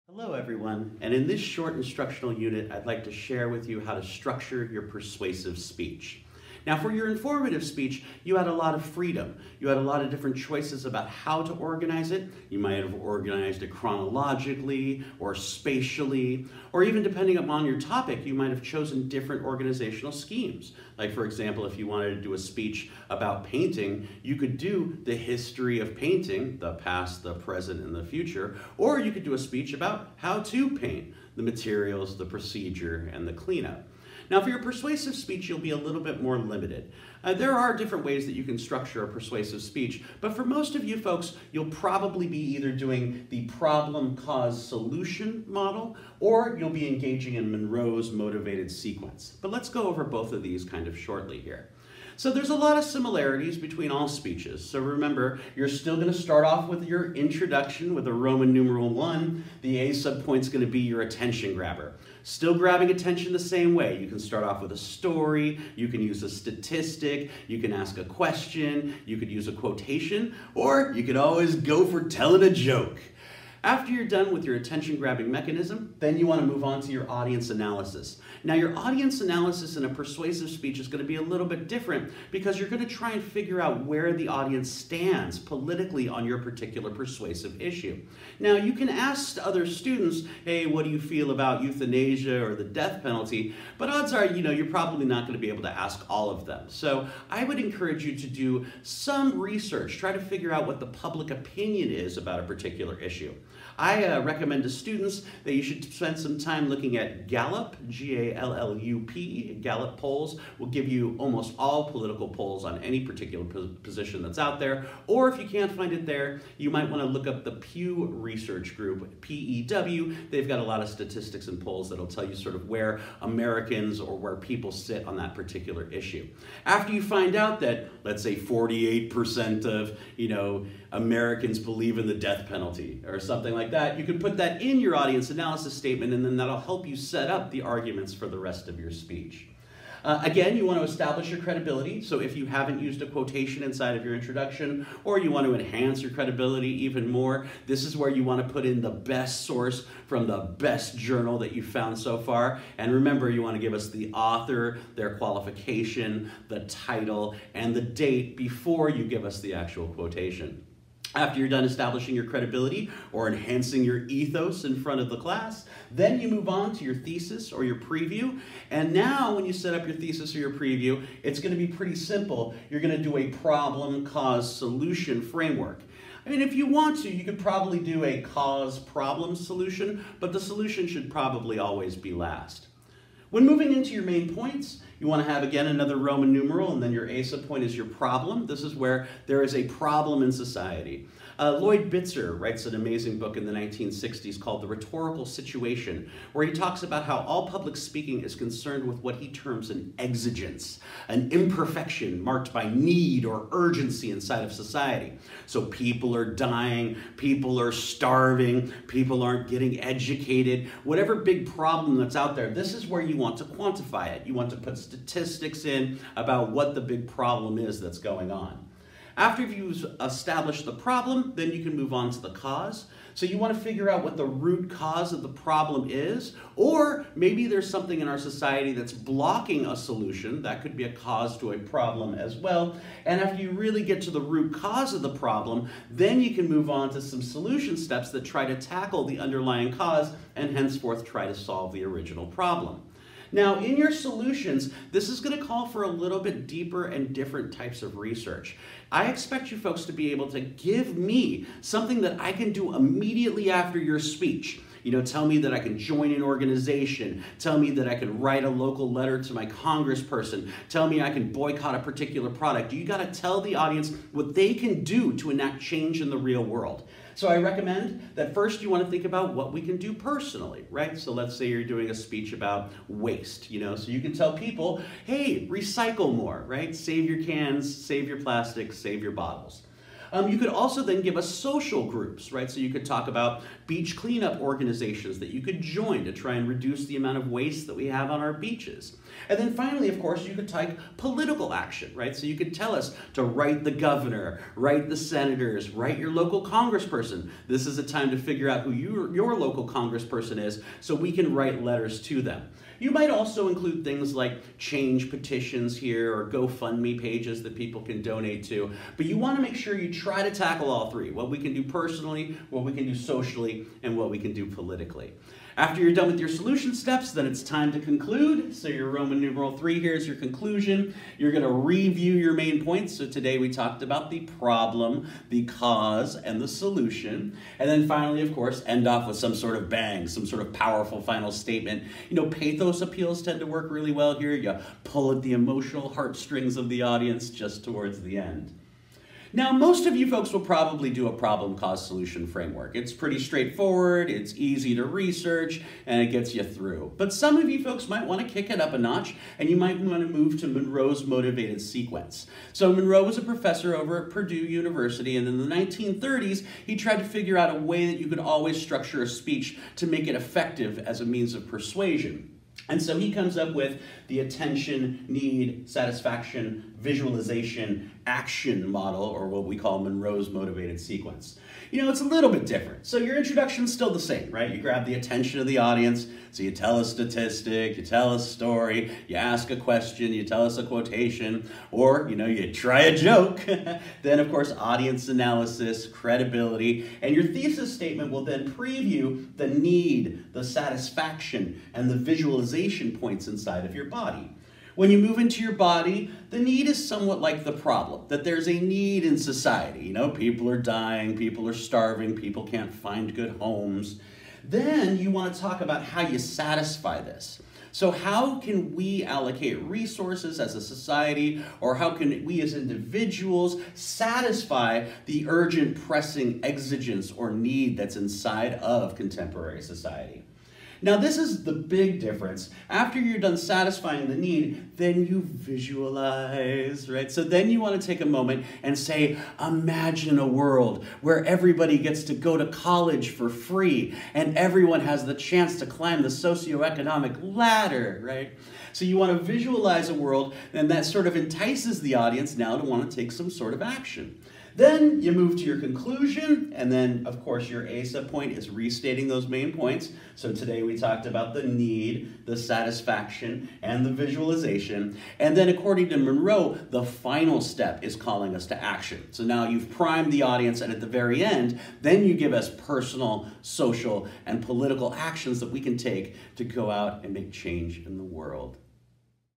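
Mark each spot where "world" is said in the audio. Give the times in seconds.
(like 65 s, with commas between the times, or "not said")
266 s, 430 s, 439 s, 468 s.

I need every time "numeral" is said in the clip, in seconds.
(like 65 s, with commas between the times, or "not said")
58 s, 186 s, 319 s.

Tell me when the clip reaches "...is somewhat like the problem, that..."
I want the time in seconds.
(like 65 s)
396 s.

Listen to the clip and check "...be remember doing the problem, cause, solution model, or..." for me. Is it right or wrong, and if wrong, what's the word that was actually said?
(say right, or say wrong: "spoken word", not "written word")
wrong: "either", not "remember".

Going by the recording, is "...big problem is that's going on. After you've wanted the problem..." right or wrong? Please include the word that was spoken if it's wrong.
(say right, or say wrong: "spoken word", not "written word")
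wrong: "established", not "wanted".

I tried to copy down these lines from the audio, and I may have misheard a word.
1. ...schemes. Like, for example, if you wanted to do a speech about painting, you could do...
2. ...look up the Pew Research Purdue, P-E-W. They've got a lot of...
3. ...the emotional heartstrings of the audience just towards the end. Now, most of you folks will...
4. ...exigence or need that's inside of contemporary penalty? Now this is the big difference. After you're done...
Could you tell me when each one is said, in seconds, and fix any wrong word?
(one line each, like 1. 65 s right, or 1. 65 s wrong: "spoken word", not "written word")
1. 20 s right
2. 117 s wrong: "Group", not "Purdue"
3. 335 s right
4. 416 s wrong: "society", not "penalty".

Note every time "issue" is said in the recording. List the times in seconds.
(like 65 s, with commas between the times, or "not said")
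87 s, 102 s, 125 s.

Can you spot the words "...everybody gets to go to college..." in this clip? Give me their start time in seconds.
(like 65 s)
431 s.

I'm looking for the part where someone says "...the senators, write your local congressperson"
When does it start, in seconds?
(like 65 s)
294 s.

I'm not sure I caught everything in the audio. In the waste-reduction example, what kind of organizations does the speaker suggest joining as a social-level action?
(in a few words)
beach cleanup organizations.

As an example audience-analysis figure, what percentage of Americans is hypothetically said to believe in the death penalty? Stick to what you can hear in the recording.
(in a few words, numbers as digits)
48%.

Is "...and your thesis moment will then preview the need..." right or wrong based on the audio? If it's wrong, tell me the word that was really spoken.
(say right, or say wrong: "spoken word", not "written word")
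wrong: "statement", not "moment".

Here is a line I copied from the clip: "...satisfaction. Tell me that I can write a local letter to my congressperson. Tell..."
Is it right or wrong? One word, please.
wrong.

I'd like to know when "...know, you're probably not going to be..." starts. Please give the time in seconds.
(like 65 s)
94 s.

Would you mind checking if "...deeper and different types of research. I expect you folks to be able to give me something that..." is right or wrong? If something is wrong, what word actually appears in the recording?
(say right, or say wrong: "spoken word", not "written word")
right.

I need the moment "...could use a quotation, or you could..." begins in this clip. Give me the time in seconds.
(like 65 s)
69 s.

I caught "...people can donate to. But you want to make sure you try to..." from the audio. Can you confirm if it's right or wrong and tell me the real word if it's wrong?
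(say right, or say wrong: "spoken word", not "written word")
right.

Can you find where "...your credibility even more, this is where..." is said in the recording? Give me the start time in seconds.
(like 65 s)
146 s.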